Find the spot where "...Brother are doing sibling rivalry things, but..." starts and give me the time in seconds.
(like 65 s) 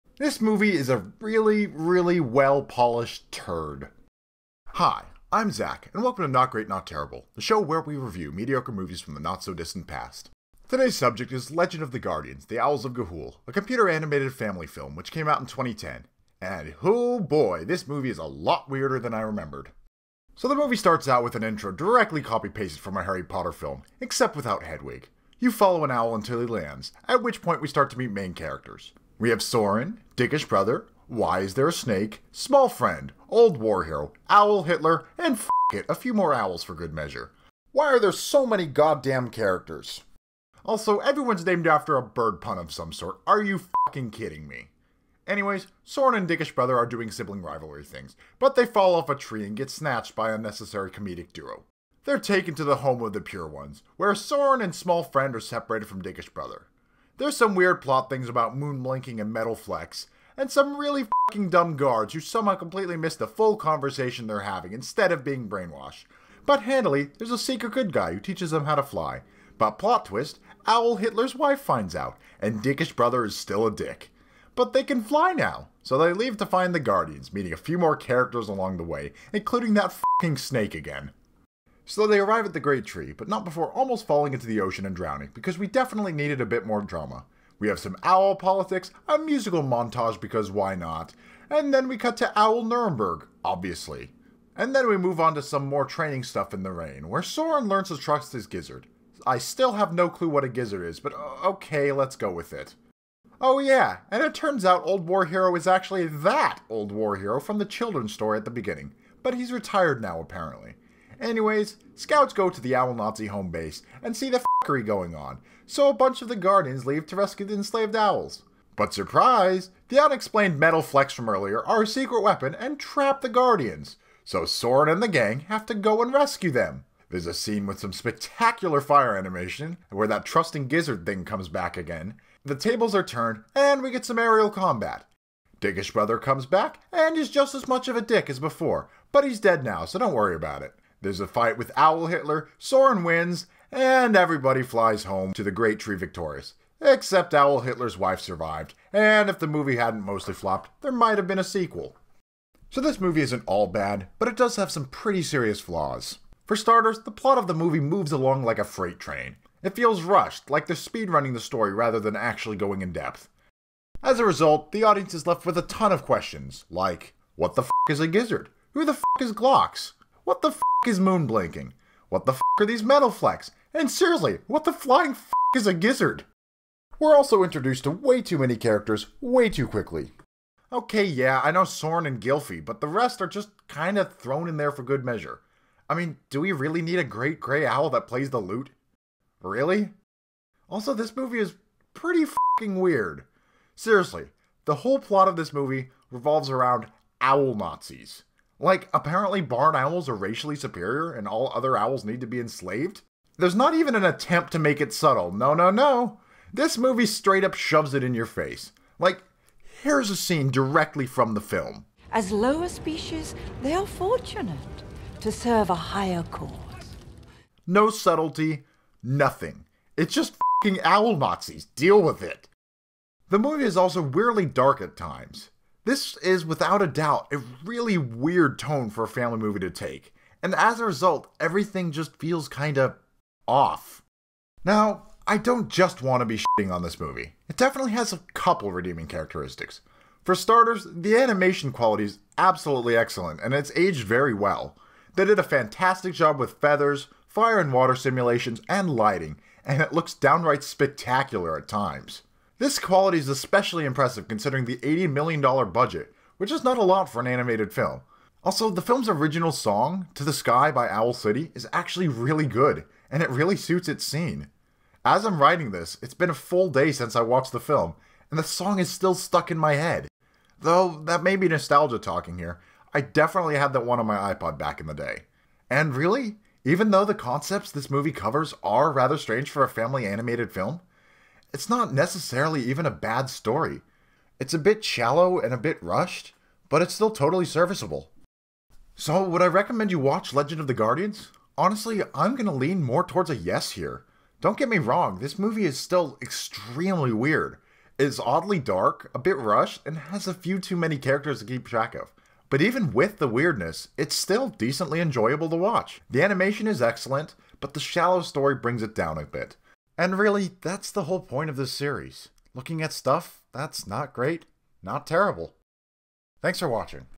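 46 s.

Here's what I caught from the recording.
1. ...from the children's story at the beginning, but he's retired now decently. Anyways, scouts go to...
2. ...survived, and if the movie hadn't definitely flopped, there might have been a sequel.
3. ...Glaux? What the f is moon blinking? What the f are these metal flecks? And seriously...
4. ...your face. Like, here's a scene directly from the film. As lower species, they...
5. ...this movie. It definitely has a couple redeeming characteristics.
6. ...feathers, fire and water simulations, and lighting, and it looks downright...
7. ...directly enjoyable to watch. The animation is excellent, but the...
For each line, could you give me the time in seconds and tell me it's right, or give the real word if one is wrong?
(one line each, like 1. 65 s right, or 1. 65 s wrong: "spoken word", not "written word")
1. 107 s wrong: "apparently", not "decently"
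2. 148 s wrong: "mostly", not "definitely"
3. 169 s right
4. 208 s right
5. 236 s right
6. 246 s right
7. 304 s wrong: "decently", not "directly".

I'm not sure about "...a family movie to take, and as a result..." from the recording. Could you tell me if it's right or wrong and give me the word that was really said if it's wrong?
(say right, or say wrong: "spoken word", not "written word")
right.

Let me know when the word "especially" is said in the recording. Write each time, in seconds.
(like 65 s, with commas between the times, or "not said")
253 s.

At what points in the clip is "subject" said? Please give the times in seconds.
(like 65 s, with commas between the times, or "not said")
10 s.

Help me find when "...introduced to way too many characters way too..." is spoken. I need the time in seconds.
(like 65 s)
177 s.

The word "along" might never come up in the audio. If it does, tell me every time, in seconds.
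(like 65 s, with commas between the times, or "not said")
78 s, 158 s.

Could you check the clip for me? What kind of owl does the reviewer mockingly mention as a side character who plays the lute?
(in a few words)
great gray owl.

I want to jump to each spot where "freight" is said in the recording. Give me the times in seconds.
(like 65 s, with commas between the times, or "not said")
158 s.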